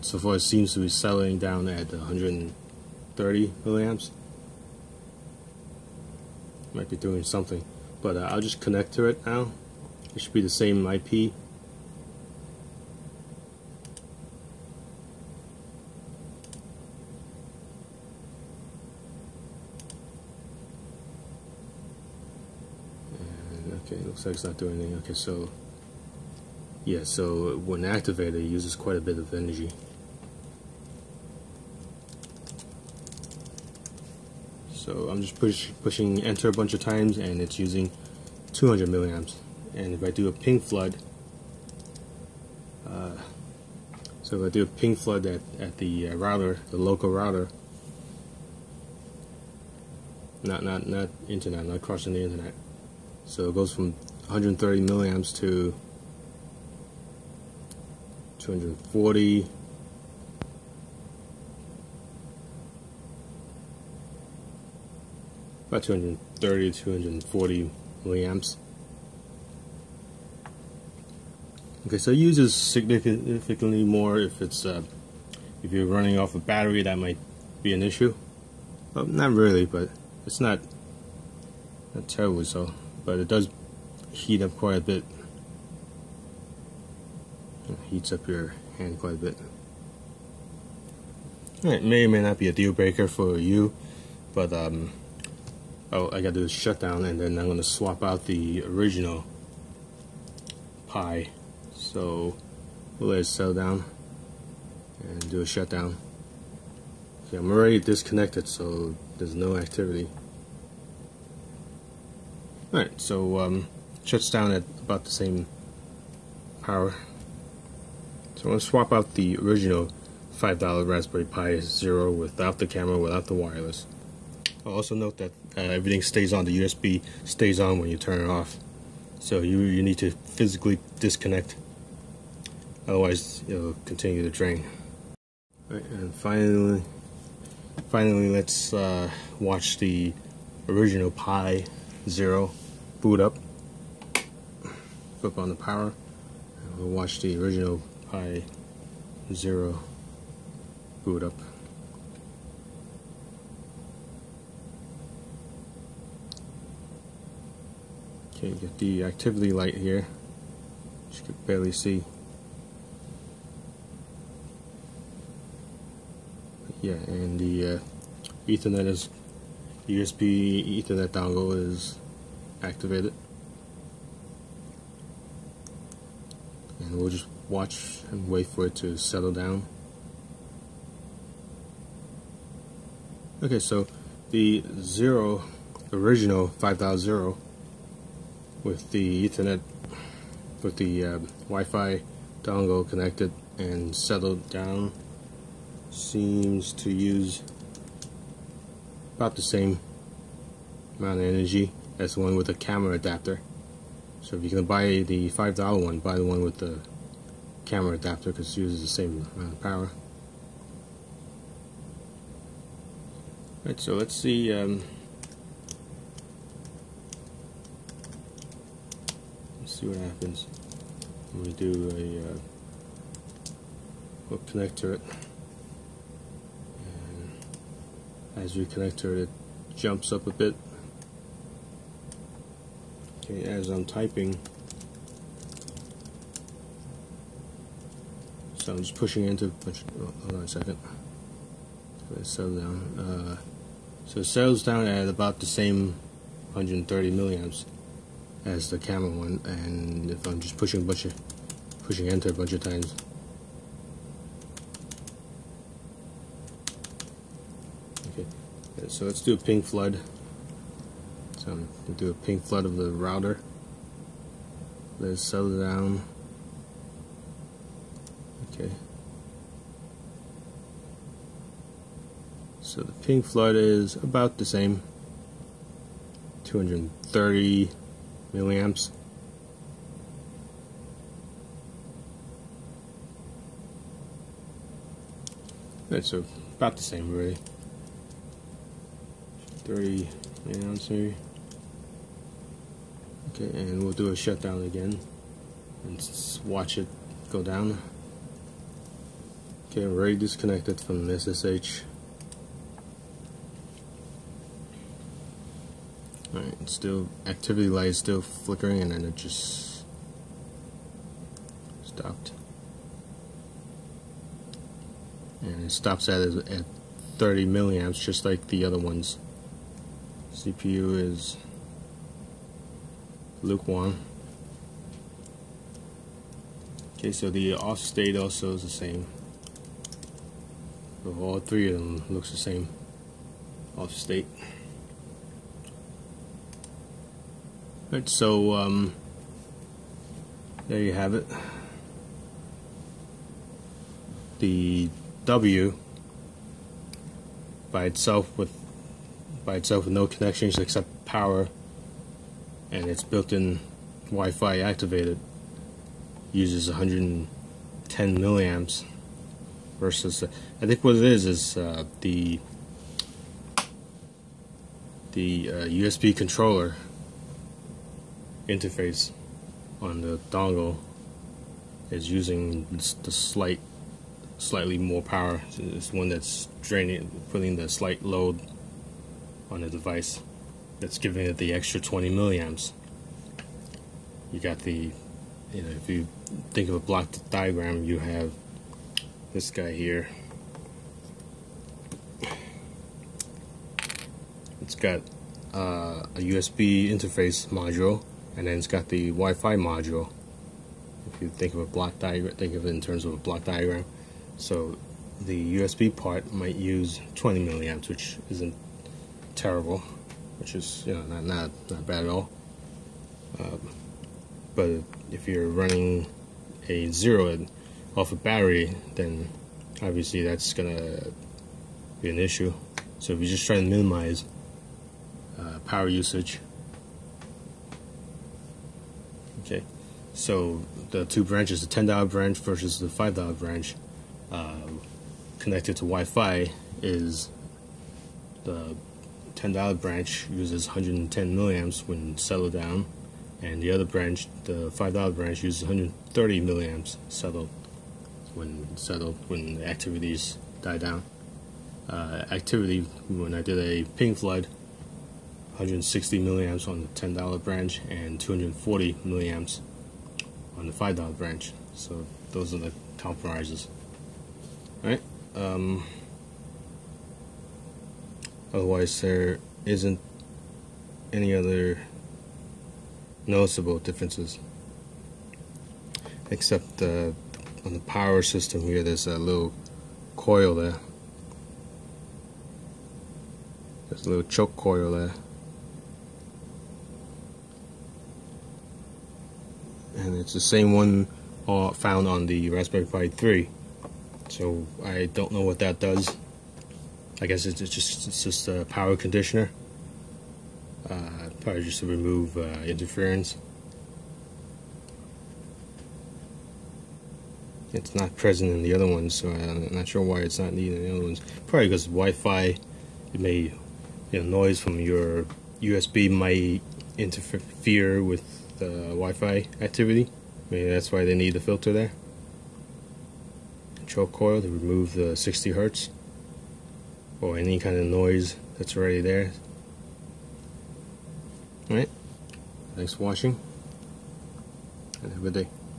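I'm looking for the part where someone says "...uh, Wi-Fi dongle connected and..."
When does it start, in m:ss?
3:11.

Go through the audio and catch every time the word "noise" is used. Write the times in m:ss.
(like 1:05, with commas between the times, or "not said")
8:34, 8:47.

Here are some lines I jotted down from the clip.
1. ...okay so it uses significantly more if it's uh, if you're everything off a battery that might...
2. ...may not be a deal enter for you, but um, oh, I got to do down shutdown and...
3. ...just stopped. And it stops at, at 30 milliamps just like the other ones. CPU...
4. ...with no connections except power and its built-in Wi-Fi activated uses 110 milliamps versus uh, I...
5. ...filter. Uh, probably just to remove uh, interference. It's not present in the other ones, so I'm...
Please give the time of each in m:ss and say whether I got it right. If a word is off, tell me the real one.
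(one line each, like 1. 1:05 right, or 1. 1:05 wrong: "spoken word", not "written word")
1. 1:11 wrong: "running", not "everything"
2. 1:32 wrong: "breaker", not "enter"
3. 5:09 right
4. 5:49 right
5. 8:18 wrong: "conditioner", not "filter".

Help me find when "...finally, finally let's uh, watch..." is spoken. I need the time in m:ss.
2:16.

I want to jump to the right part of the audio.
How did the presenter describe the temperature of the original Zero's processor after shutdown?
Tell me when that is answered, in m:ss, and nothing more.
5:23.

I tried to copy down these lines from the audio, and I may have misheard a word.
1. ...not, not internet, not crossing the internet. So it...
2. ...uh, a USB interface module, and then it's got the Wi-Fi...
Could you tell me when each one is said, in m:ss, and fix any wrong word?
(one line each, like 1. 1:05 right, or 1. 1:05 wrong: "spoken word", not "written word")
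1. 0:50 right
2. 6:35 right.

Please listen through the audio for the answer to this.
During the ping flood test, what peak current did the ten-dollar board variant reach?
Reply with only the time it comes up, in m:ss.
7:35.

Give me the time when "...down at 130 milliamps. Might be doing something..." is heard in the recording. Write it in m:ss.
0:01.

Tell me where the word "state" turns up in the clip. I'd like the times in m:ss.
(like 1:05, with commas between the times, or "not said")
5:27, 5:33.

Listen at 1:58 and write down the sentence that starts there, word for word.
So I'm going to swap out the original $5 Raspberry Pi Zero without the camera, without the wireless.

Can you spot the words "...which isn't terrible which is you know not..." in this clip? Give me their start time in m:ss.
6:47.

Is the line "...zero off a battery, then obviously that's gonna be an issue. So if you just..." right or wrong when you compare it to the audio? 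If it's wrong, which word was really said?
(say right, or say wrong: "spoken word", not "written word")
right.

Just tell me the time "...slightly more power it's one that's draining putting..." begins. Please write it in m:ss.
6:14.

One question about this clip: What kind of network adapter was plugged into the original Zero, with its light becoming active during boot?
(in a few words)
USB Ethernet dongle.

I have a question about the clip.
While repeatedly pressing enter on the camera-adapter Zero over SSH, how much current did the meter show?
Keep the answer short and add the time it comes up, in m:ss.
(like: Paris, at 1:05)
200 milliamps, at 0:38.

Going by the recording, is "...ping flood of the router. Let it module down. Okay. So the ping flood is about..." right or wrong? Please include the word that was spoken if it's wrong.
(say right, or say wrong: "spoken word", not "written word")
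wrong: "settle", not "module".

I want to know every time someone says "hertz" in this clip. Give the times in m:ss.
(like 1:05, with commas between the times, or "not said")
8:45.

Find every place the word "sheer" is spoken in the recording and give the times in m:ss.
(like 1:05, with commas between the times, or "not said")
not said.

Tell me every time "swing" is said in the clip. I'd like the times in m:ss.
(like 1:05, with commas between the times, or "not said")
not said.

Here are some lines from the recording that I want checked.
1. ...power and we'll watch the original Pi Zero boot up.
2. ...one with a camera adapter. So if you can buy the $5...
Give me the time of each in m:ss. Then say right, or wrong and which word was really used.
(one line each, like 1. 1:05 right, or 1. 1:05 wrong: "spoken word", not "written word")
1. 2:25 right
2. 3:22 right.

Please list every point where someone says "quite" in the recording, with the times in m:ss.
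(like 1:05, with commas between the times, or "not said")
0:28, 1:24, 1:28.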